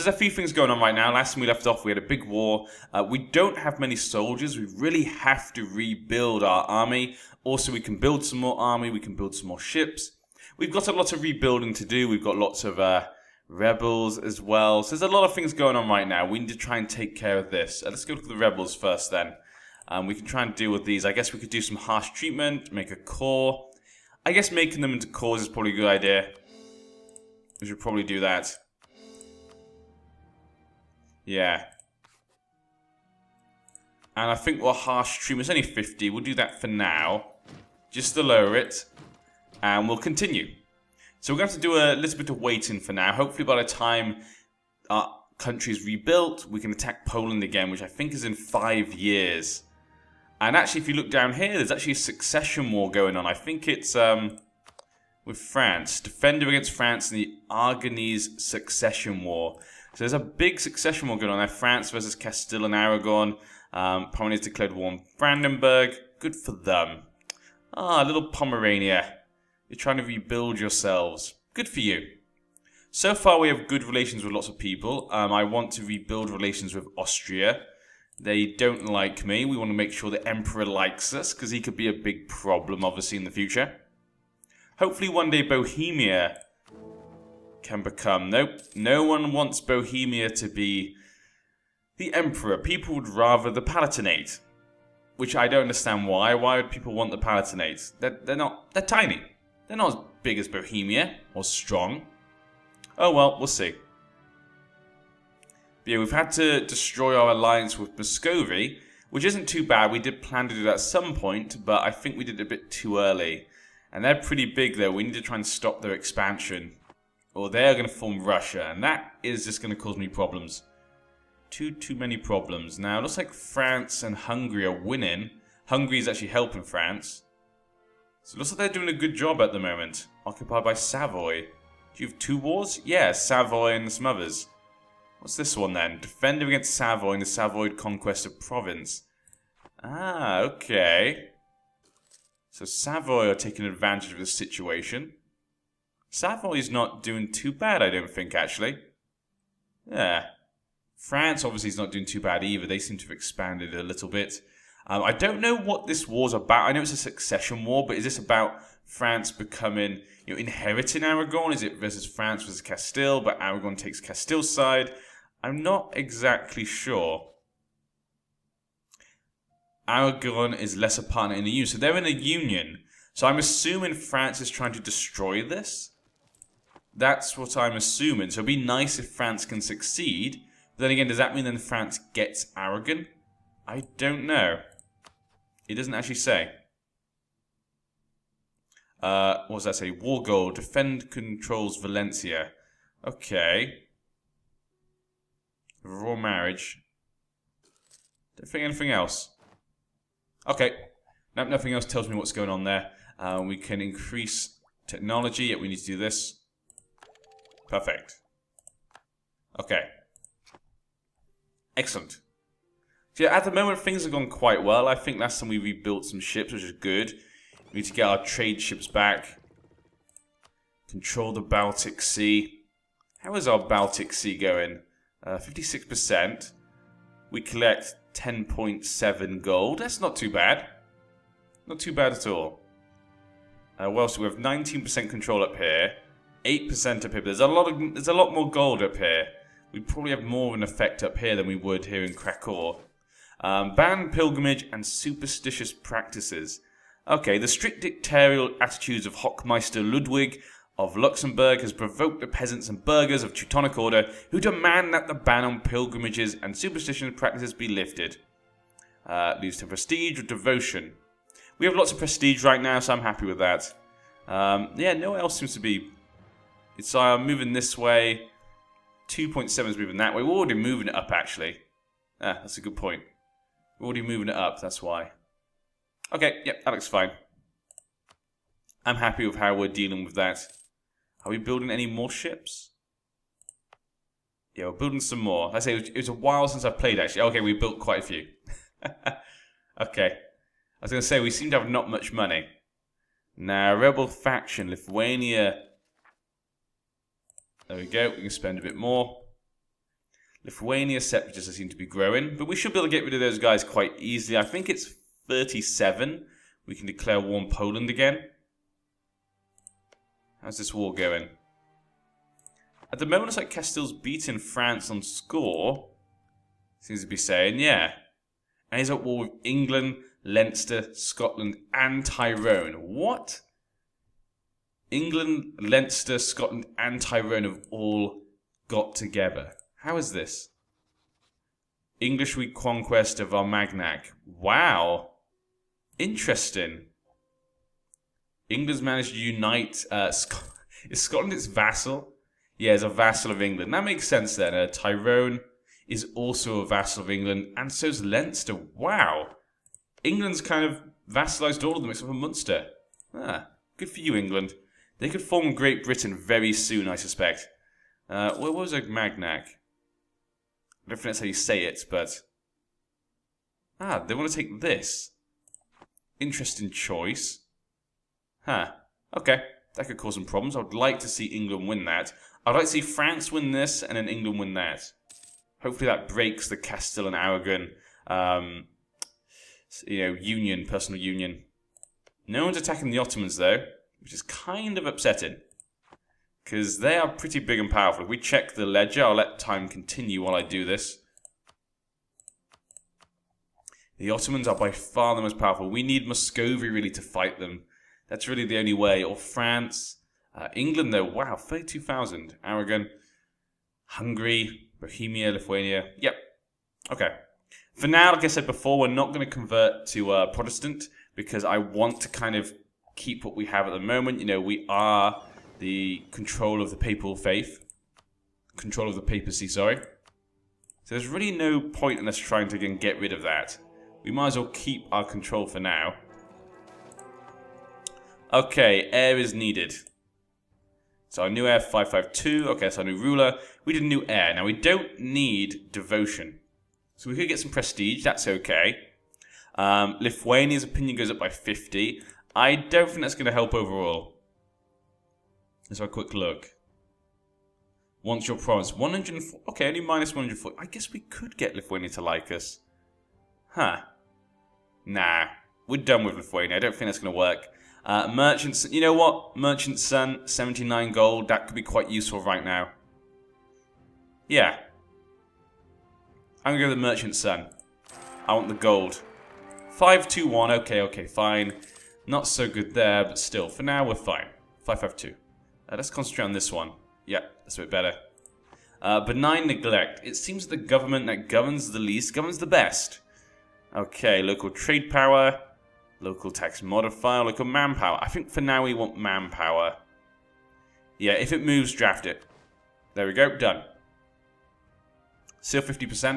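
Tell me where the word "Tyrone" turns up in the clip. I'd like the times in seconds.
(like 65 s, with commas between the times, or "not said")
322 s, 327 s, 344 s.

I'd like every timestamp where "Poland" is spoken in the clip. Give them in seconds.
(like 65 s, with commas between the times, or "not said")
47 s, 307 s.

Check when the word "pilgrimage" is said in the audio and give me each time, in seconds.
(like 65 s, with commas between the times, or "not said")
244 s, 255 s.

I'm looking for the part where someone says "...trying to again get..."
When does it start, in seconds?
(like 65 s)
422 s.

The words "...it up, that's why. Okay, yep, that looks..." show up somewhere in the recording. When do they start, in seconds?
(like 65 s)
274 s.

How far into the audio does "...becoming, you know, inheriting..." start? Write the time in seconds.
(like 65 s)
159 s.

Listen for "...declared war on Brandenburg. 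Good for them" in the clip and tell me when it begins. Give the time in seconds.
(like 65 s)
64 s.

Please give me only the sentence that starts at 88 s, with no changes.
Nope, no one wants Bohemia to be the emperor.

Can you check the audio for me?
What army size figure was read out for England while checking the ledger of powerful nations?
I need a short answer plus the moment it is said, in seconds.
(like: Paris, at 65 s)
32,000, at 401 s.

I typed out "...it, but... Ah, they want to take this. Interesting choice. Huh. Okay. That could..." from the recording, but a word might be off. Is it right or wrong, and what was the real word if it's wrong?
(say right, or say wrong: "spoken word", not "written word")
right.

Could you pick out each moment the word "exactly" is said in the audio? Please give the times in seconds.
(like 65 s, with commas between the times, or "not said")
165 s.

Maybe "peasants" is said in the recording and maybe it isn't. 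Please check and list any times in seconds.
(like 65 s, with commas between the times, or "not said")
252 s.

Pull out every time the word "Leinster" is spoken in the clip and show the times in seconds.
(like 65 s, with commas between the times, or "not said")
320 s, 325 s, 348 s.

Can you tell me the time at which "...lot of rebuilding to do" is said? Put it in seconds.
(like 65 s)
10 s.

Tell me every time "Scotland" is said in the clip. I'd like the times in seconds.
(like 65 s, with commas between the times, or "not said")
320 s, 326 s, 341 s.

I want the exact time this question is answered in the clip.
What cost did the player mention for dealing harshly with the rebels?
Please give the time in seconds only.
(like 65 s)
35 s.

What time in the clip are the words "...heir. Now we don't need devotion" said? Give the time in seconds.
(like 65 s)
434 s.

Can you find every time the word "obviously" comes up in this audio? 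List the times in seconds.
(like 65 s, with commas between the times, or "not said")
82 s, 151 s.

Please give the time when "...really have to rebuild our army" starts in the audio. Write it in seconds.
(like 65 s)
4 s.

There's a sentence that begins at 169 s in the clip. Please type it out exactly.
Aragon is less a partner in the EU, so they're in a union.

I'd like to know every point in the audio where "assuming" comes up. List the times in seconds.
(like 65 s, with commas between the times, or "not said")
173 s, 177 s.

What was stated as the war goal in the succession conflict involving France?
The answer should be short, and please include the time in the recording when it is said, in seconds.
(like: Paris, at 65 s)
Valencia, at 191 s.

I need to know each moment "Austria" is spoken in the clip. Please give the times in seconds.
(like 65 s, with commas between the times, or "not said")
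76 s.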